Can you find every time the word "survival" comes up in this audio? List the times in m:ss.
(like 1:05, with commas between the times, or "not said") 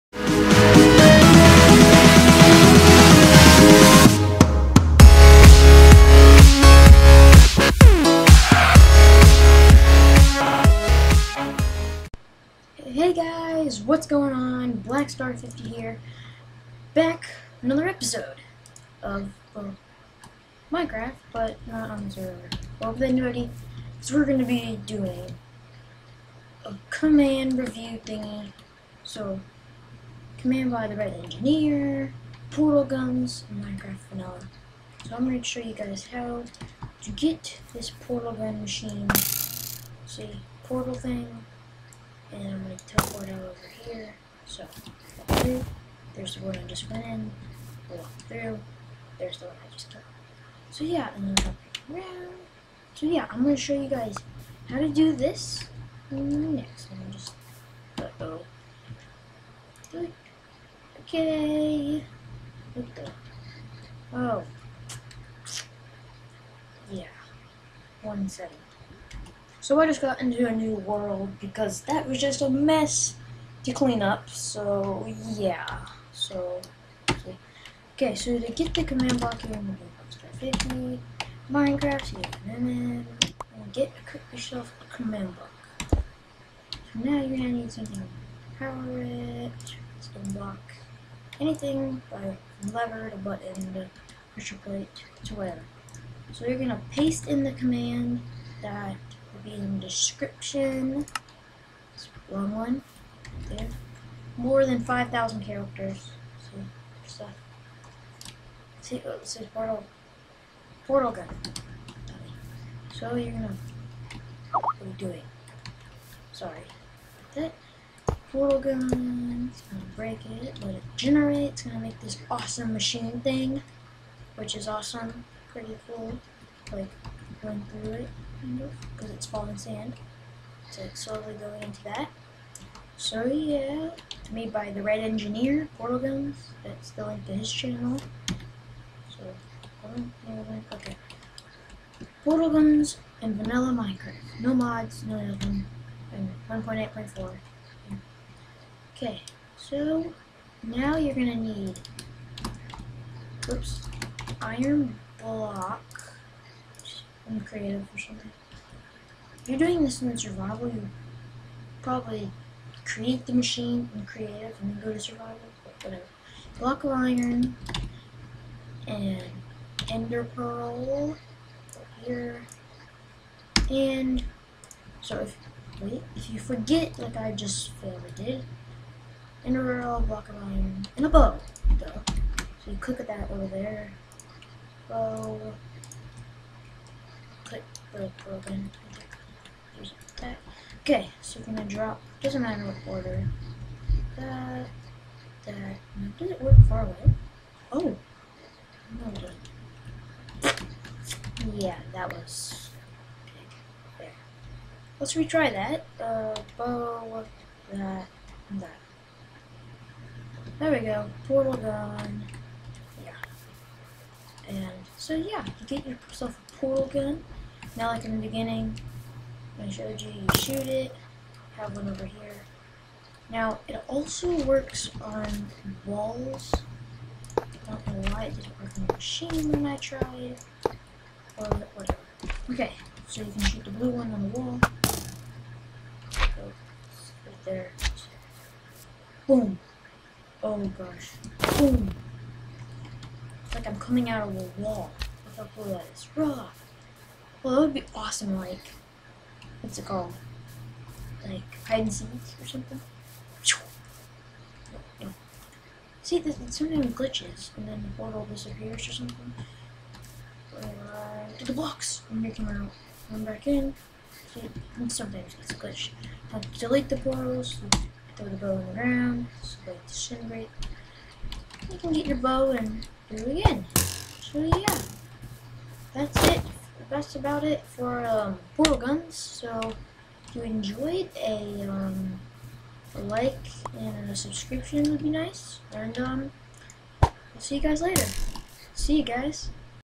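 2:40, 2:44.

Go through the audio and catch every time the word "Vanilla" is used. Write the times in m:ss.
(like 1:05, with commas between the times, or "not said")
0:34, 2:23.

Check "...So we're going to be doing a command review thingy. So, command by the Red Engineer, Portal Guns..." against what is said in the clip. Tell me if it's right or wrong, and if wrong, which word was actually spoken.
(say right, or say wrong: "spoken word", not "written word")
right.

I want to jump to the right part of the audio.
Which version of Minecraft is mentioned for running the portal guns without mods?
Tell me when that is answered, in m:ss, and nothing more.
2:26.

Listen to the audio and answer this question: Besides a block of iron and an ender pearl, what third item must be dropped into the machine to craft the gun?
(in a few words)
A bow.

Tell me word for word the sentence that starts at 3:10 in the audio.
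Okay, so we're gonna drop, doesn't matter what order.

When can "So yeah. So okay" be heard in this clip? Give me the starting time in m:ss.
1:14.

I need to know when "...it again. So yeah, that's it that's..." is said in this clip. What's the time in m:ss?
4:33.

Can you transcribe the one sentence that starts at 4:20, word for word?
Right to the blocks, and they come out, come back in.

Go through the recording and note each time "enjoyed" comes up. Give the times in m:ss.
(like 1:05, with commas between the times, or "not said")
4:40.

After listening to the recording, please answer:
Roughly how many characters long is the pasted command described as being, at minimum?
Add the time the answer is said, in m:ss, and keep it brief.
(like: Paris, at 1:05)
5,000, at 1:44.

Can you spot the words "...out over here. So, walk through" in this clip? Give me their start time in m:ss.
0:43.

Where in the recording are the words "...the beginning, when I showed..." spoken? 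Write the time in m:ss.
3:38.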